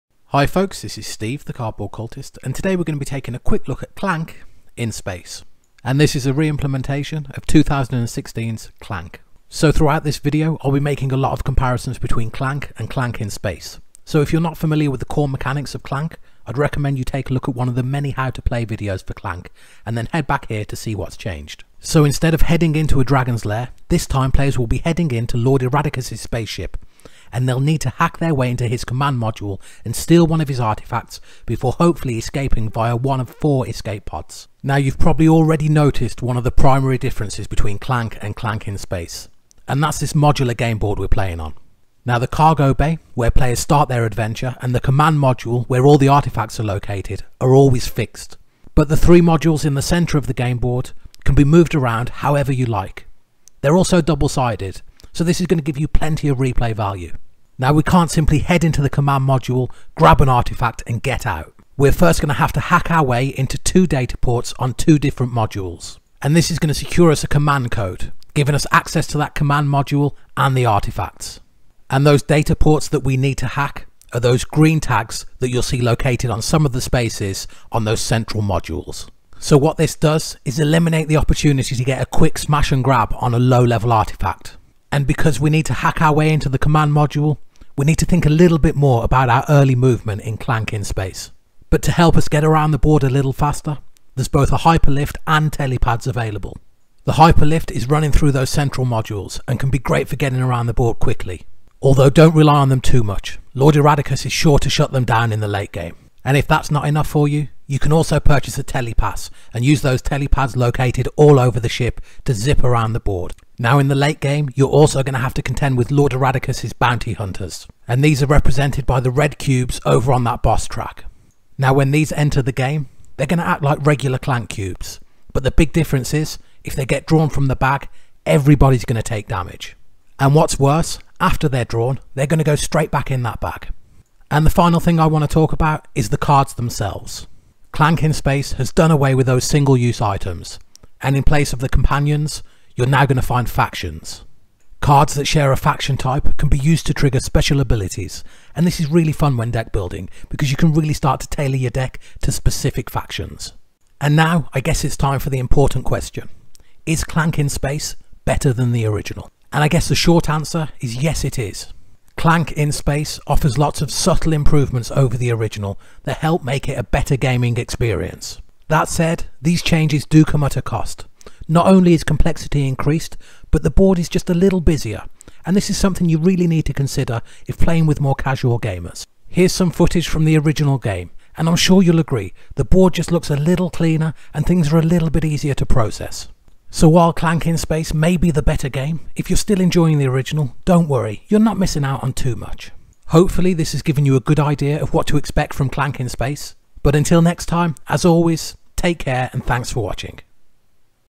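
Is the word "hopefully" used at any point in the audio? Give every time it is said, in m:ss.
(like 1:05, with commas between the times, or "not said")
0:31, 3:13.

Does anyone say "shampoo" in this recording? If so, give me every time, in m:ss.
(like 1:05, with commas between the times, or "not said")
not said.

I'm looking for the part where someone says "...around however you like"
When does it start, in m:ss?
0:51.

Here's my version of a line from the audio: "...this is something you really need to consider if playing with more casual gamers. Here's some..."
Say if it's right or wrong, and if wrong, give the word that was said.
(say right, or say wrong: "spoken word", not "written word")
right.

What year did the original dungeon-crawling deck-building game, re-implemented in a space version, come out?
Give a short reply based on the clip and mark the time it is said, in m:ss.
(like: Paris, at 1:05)
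2016, at 0:07.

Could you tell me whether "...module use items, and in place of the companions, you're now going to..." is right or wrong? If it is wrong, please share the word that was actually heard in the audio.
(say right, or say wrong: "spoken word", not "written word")
wrong: "single", not "module".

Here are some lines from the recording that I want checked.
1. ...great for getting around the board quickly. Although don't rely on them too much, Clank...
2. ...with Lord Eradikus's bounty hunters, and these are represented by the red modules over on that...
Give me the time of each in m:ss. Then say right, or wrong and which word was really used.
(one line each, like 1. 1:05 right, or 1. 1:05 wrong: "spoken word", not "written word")
1. 1:39 wrong: "Lord", not "Clank"
2. 1:55 wrong: "cubes", not "modules".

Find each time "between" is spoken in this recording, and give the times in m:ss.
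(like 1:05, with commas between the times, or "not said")
0:11, 0:37.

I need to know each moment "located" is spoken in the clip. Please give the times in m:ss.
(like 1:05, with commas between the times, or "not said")
0:46, 1:15, 1:50.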